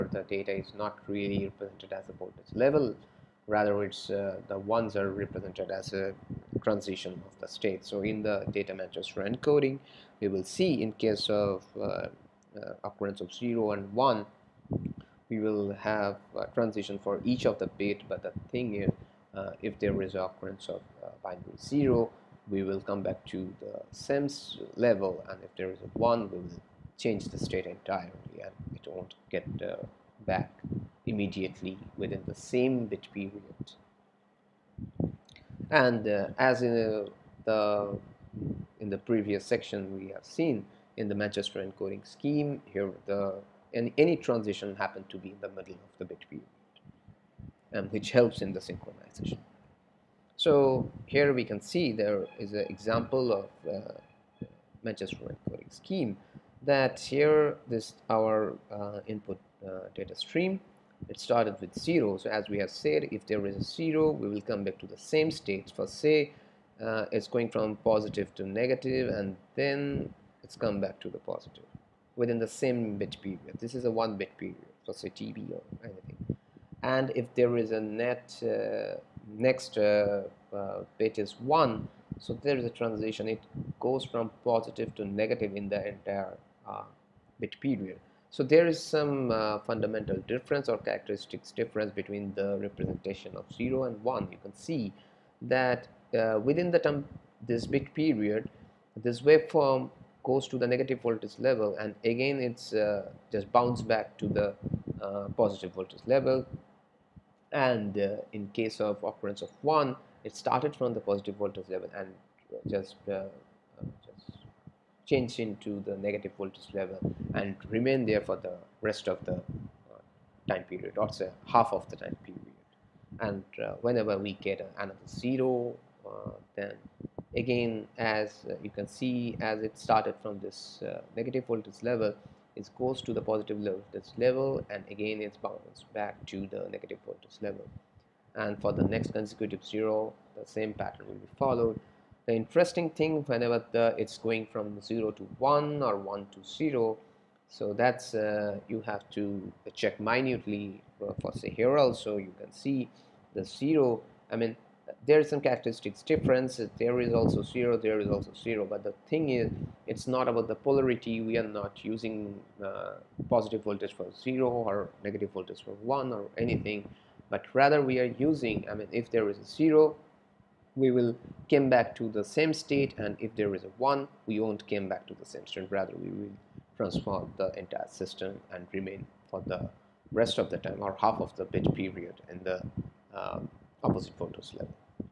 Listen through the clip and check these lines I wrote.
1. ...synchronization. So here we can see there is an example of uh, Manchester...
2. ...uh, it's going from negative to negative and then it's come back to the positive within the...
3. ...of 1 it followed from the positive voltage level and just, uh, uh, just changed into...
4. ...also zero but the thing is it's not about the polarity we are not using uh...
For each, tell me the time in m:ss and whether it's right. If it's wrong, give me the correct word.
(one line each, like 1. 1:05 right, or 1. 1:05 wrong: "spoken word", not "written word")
1. 0:48 right
2. 1:06 wrong: "positive", not "negative"
3. 1:49 wrong: "started", not "followed"
4. 2:38 right.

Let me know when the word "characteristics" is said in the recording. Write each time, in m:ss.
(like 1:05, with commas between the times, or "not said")
1:30, 2:35.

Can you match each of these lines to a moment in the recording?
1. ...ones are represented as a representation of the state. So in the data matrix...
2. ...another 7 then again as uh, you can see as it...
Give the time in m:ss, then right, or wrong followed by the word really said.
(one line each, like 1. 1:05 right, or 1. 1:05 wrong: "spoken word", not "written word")
1. 0:04 wrong: "transition", not "representation"
2. 2:04 wrong: "0", not "7".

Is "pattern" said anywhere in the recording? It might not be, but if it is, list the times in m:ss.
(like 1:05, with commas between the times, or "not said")
2:20.